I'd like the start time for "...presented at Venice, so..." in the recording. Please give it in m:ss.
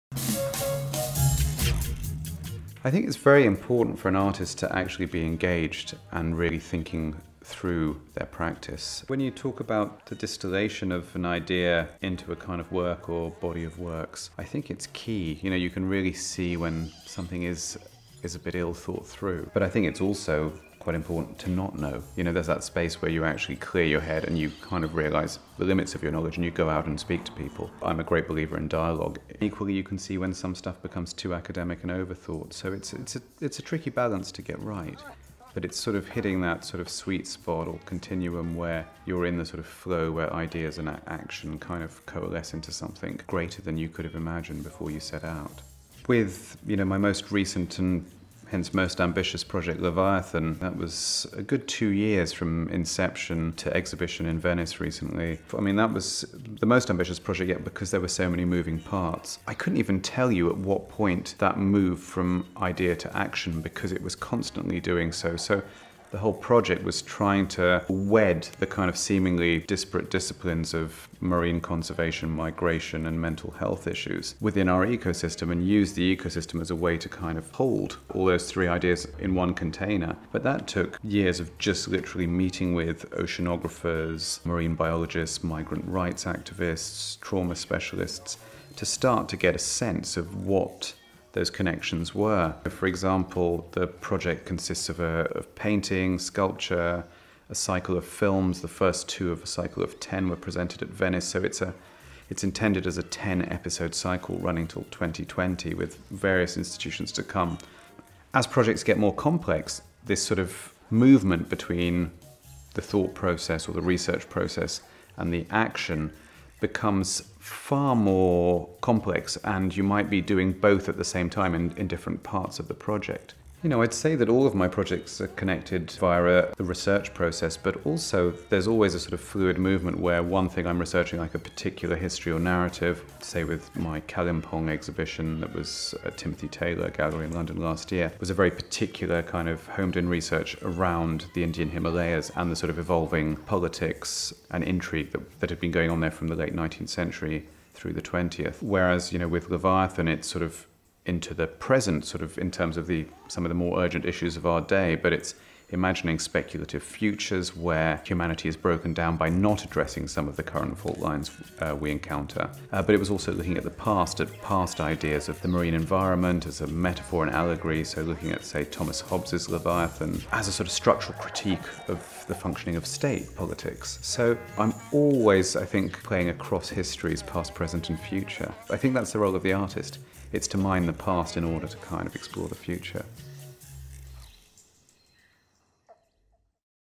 1:40.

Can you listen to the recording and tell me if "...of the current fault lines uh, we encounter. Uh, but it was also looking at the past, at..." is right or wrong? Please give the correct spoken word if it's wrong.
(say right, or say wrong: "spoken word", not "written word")
right.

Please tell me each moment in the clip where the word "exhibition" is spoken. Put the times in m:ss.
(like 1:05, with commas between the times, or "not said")
0:53, 2:14.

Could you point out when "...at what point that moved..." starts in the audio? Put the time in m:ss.
1:00.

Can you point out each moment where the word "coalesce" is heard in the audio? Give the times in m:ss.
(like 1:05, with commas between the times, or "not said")
0:42.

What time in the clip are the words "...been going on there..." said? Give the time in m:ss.
2:25.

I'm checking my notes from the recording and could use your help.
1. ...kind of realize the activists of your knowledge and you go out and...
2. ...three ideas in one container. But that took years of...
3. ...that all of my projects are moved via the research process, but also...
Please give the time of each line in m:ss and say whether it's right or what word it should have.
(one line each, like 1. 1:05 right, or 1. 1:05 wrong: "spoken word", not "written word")
1. 0:24 wrong: "limits", not "activists"
2. 1:18 right
3. 2:04 wrong: "connected", not "moved".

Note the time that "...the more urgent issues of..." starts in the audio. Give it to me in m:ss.
2:33.